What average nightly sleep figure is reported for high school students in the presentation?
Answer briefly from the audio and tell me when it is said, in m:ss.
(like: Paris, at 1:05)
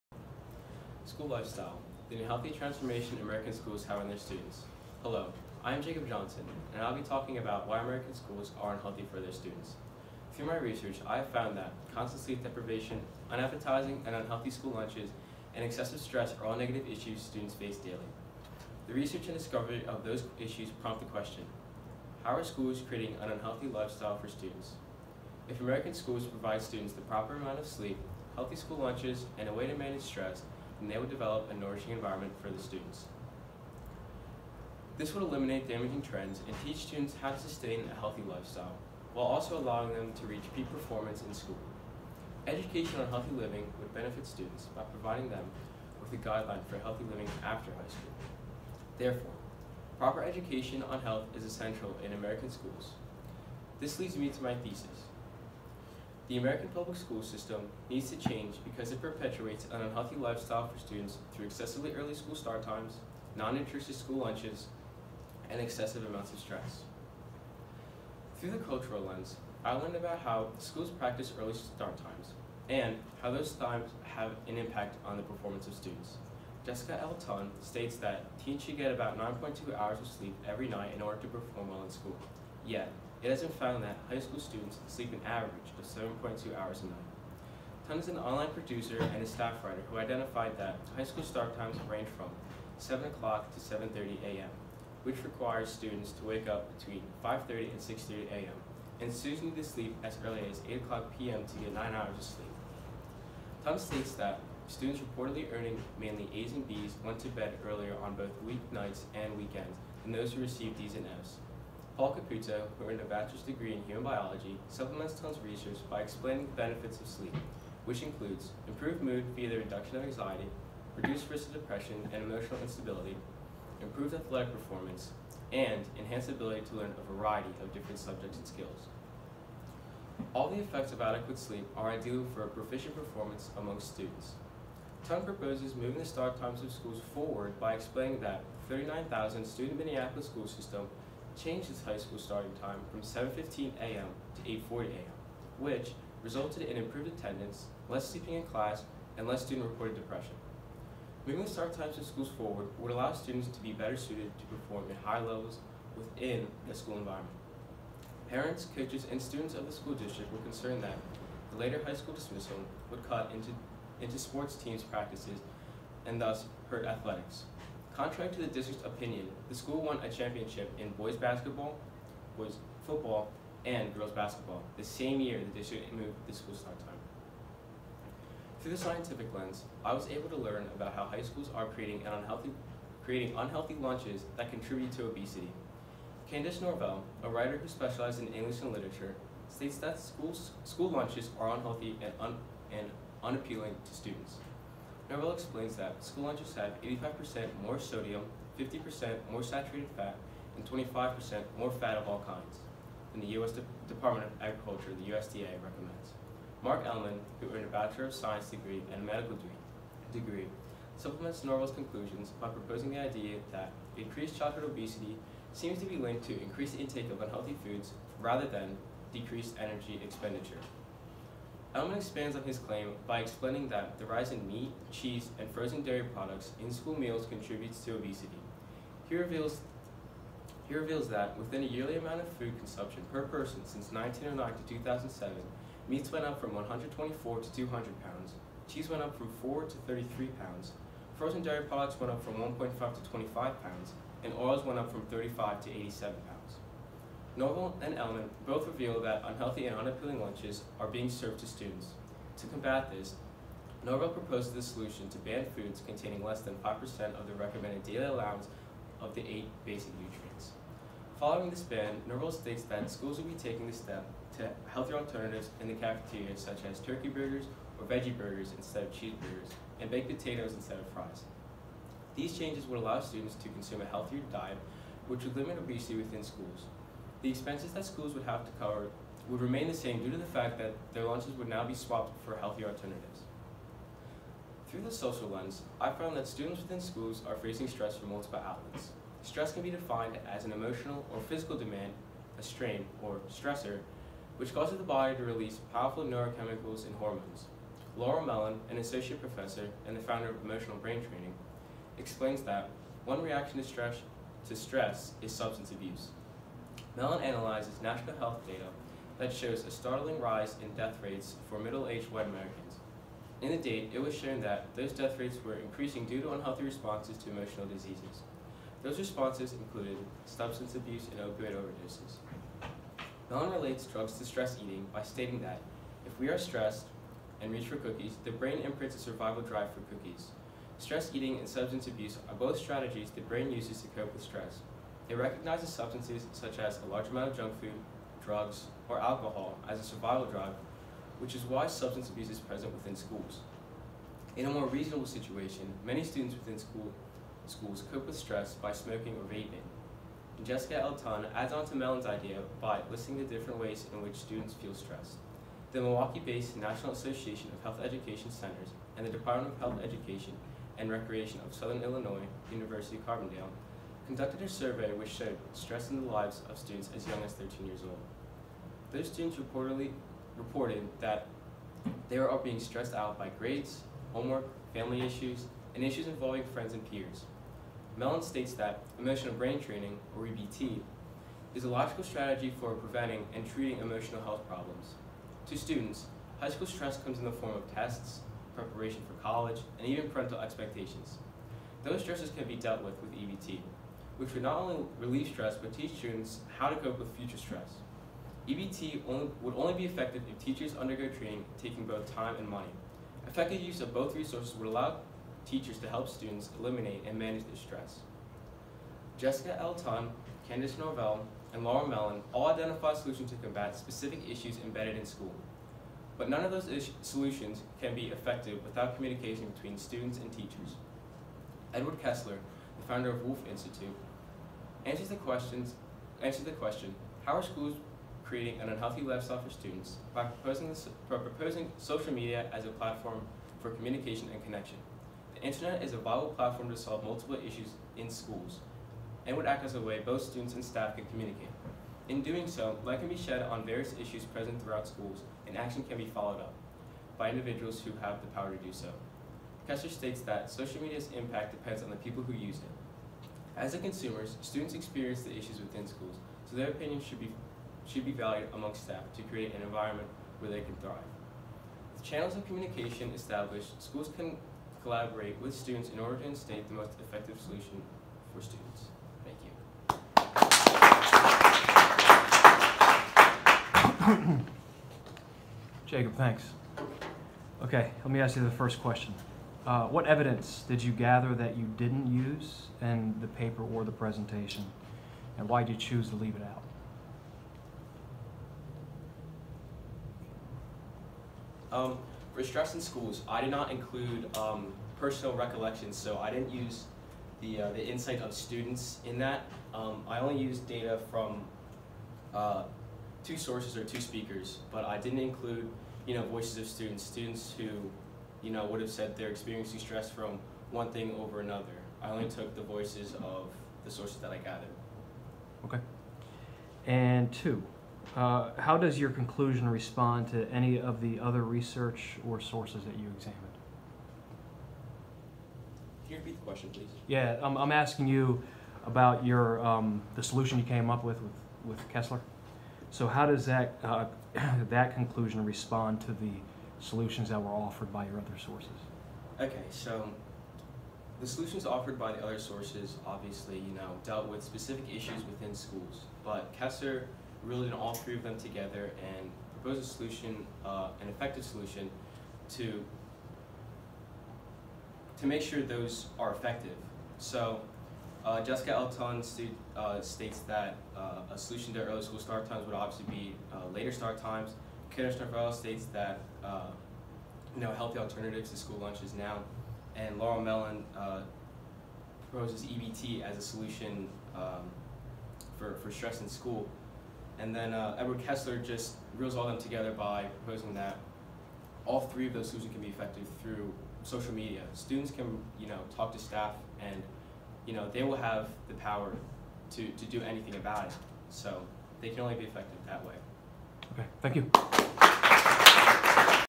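7.2 hours, at 1:25.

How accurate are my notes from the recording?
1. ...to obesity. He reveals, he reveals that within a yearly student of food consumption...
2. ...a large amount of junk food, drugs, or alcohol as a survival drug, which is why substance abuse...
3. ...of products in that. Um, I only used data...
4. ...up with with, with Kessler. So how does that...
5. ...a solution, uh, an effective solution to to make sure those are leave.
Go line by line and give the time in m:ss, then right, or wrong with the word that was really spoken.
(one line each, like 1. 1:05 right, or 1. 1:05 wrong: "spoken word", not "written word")
1. 3:47 wrong: "amount", not "student"
2. 5:36 right
3. 8:18 wrong: "students", not "products"
4. 8:50 right
5. 9:09 wrong: "effective", not "leave".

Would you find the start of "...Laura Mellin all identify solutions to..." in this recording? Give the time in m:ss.
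6:51.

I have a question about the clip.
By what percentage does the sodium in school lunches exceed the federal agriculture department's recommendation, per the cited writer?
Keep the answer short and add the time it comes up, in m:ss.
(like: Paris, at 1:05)
85%, at 3:16.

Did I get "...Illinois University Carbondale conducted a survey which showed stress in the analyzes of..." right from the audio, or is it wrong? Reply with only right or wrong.
wrong.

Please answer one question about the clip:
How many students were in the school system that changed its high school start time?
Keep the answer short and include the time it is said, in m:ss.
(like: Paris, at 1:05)
39,000, at 2:18.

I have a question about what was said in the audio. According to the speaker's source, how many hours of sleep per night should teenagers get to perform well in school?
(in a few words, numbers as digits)
9.2 hours.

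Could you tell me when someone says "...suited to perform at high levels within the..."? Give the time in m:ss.
2:33.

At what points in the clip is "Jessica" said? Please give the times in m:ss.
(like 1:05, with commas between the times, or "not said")
1:16, 5:50, 6:49, 9:18.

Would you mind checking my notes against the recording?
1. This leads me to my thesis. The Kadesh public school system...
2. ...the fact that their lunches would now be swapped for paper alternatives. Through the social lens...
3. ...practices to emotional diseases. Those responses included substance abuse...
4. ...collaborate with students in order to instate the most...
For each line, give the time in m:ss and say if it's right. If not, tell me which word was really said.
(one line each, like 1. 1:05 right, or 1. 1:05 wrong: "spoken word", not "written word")
1. 0:53 wrong: "American", not "Kadesh"
2. 4:40 wrong: "healthier", not "paper"
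3. 5:16 wrong: "responses", not "practices"
4. 7:44 right.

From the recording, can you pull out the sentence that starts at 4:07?
Norval and Elman both reveal that unhealthy and unappealing lunches are being served to students.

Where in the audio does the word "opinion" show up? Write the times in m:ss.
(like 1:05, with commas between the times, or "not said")
2:48, 7:36.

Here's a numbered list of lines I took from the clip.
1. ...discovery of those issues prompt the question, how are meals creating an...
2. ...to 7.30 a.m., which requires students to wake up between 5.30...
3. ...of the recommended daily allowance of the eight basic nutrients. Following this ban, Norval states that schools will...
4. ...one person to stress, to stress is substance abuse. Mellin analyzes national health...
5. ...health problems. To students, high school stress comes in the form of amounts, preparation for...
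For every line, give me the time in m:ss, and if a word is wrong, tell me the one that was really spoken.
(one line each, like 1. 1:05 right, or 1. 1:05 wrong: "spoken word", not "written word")
1. 0:19 wrong: "schools", not "meals"
2. 1:33 right
3. 4:17 right
4. 5:03 wrong: "reaction", not "person"
5. 6:24 wrong: "tests", not "amounts".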